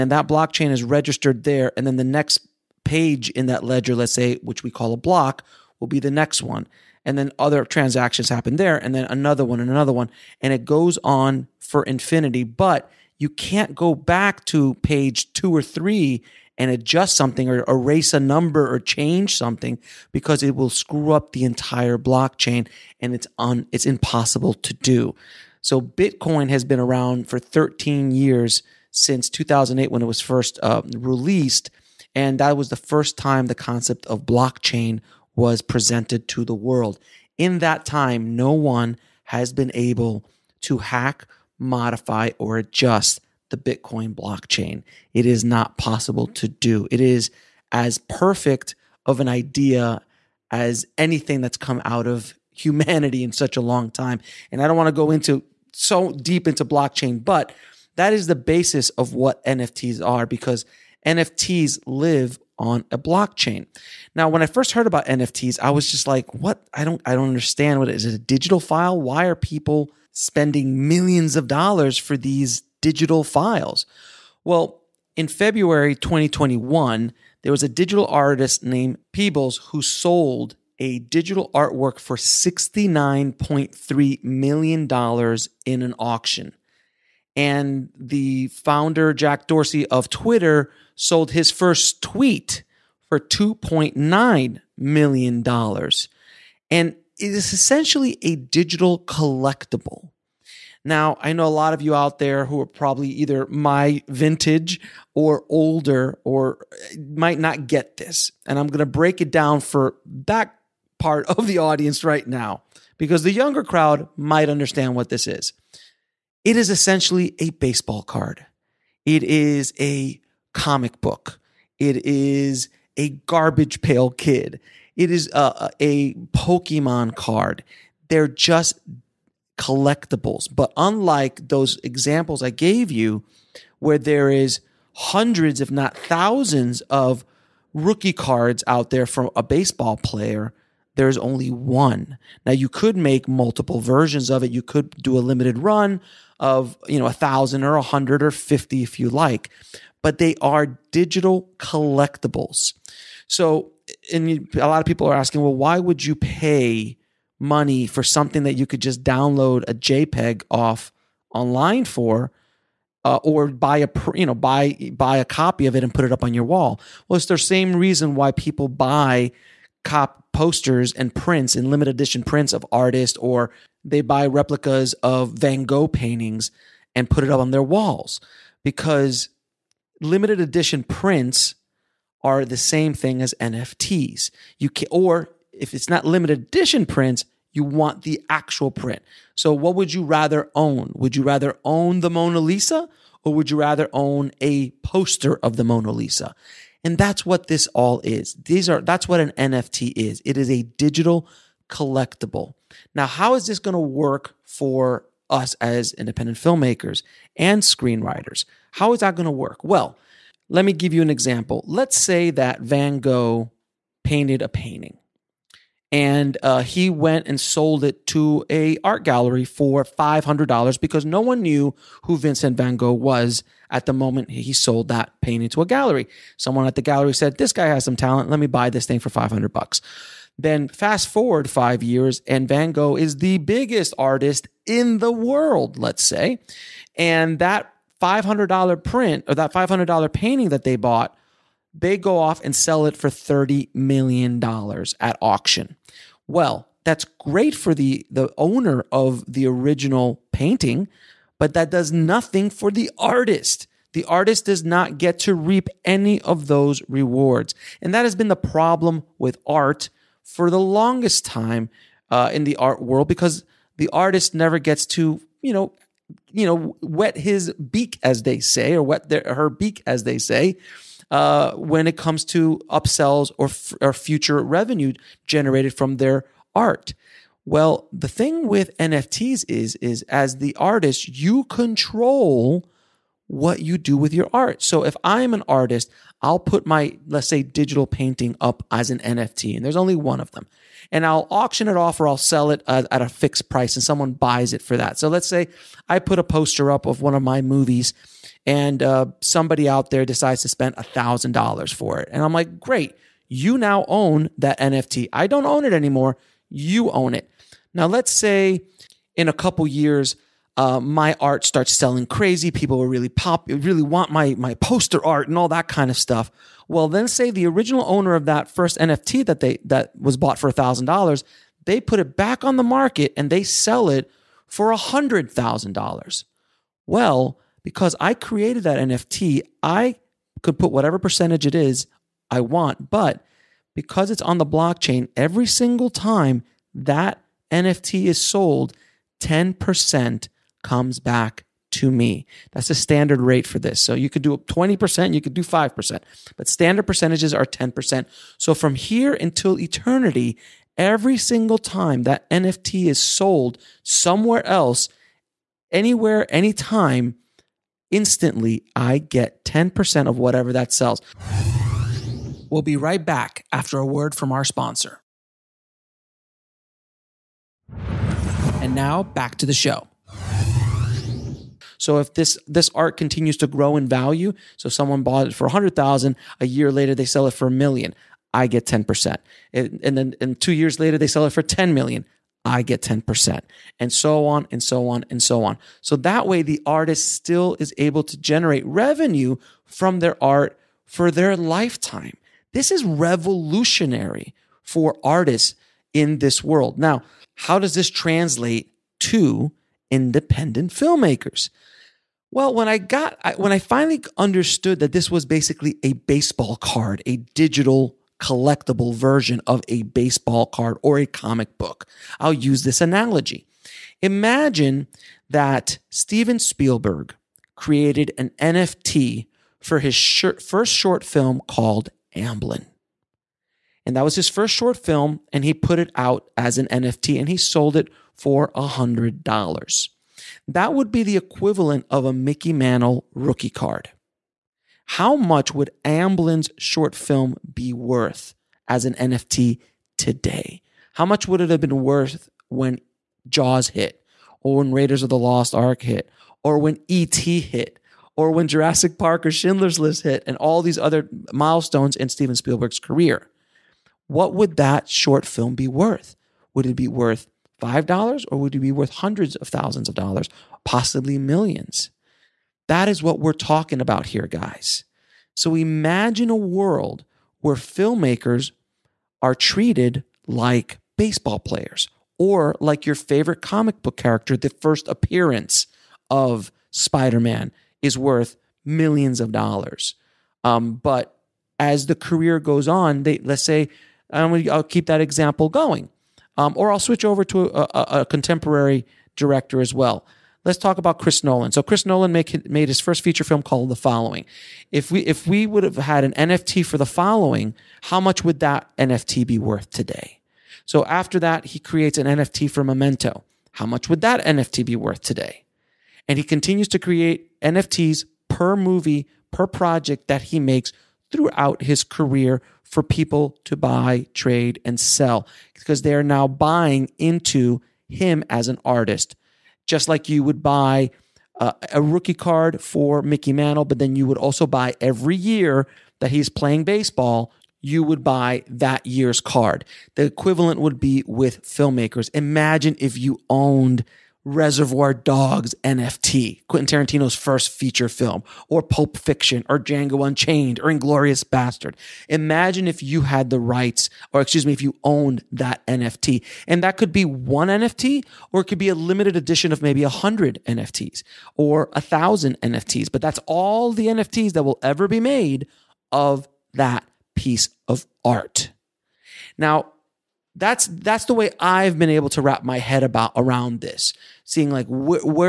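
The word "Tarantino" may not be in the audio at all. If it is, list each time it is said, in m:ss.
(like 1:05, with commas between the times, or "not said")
8:56.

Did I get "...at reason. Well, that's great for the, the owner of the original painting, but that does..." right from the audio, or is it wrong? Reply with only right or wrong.
wrong.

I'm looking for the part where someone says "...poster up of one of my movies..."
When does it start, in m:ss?
4:56.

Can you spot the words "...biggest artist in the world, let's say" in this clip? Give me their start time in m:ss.
3:53.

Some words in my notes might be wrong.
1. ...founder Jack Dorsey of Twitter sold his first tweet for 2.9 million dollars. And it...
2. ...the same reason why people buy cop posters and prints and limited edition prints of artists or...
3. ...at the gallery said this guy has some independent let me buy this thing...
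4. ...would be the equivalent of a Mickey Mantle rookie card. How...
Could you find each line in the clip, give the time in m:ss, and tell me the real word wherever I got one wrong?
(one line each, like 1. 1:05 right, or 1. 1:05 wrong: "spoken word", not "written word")
1. 1:28 right
2. 2:47 right
3. 3:46 wrong: "talent", not "independent"
4. 7:10 right.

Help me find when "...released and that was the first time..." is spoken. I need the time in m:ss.
0:30.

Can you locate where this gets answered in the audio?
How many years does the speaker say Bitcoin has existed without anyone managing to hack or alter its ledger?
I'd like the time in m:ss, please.
0:27.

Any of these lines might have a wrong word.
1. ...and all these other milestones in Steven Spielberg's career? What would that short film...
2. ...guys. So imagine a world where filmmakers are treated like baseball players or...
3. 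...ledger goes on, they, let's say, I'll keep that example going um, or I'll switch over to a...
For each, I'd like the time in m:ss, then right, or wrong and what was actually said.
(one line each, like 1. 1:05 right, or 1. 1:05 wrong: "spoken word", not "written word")
1. 7:30 right
2. 7:44 right
3. 8:01 wrong: "career", not "ledger".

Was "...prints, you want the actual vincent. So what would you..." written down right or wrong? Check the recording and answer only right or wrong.
wrong.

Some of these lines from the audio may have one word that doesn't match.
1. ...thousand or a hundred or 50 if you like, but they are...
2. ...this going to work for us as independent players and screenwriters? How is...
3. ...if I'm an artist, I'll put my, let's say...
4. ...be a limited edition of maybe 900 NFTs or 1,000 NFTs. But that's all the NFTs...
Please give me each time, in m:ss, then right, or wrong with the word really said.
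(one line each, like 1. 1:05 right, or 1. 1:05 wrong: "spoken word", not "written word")
1. 2:27 right
2. 3:23 wrong: "filmmakers", not "players"
3. 4:44 right
4. 9:08 wrong: "100", not "900".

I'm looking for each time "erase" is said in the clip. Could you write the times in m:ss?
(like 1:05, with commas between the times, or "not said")
0:17.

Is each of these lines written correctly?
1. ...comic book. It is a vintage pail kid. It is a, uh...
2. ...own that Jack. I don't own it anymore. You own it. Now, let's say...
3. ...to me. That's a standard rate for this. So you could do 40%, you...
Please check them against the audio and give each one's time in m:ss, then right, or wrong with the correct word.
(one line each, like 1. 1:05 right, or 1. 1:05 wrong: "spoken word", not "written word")
1. 2:00 wrong: "garbage", not "vintage"
2. 5:03 wrong: "NFT", not "Jack"
3. 5:41 wrong: "20", not "40".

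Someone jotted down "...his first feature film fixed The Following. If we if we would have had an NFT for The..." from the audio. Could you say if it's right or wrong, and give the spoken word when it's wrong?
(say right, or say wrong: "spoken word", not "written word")
wrong: "called", not "fixed".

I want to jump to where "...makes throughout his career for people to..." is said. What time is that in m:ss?
8:30.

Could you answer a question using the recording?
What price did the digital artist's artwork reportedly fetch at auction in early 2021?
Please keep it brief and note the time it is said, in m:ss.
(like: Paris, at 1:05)
$69.3 million, at 1:22.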